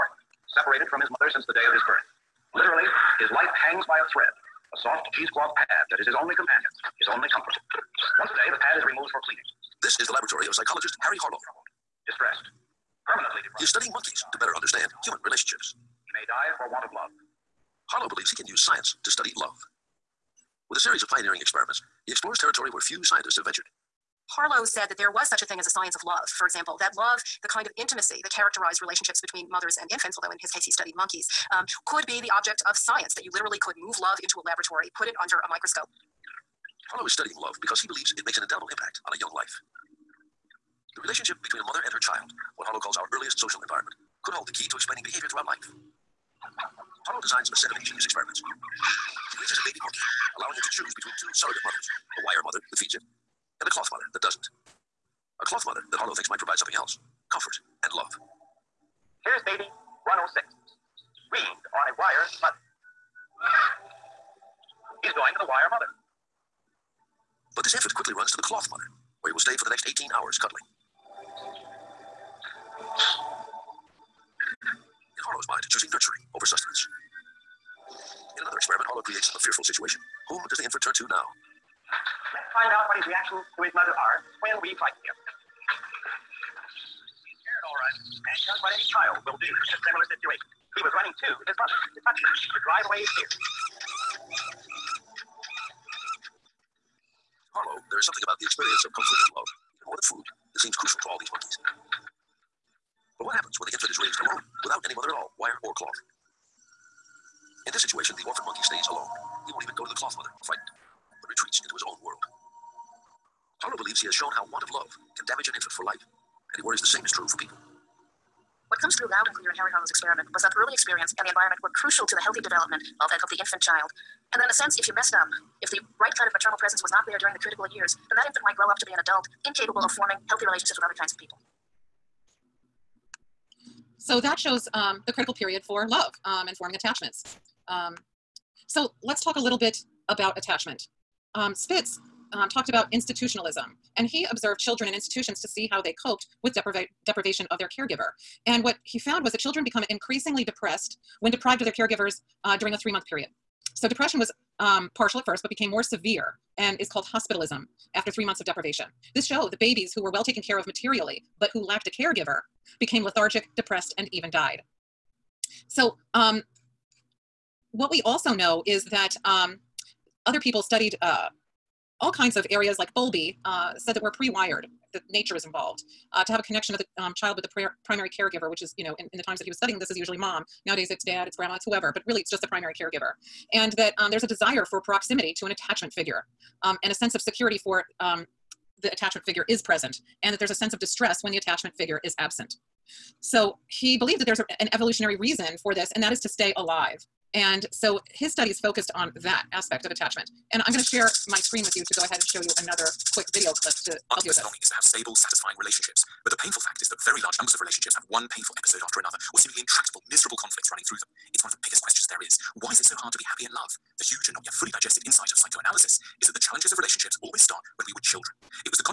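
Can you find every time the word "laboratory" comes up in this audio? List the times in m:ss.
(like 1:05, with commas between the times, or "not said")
0:10, 0:34.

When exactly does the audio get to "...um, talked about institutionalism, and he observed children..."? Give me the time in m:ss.
2:22.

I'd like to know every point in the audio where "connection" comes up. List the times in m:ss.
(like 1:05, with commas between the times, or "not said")
2:56.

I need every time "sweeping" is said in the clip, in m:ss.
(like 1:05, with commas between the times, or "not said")
not said.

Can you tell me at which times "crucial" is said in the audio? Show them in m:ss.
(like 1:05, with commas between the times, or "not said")
1:40, 2:01.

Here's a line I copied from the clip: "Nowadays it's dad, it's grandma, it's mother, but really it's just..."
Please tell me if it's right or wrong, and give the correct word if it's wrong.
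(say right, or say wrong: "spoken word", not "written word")
wrong: "whoever", not "mother".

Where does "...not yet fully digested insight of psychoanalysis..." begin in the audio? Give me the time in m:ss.
3:34.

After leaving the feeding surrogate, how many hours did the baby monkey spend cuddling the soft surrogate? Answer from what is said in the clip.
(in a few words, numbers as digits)
18.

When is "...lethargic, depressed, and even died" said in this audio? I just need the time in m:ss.
2:43.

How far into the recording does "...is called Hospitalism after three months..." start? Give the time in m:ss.
2:36.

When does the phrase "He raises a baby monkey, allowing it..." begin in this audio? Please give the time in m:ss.
0:48.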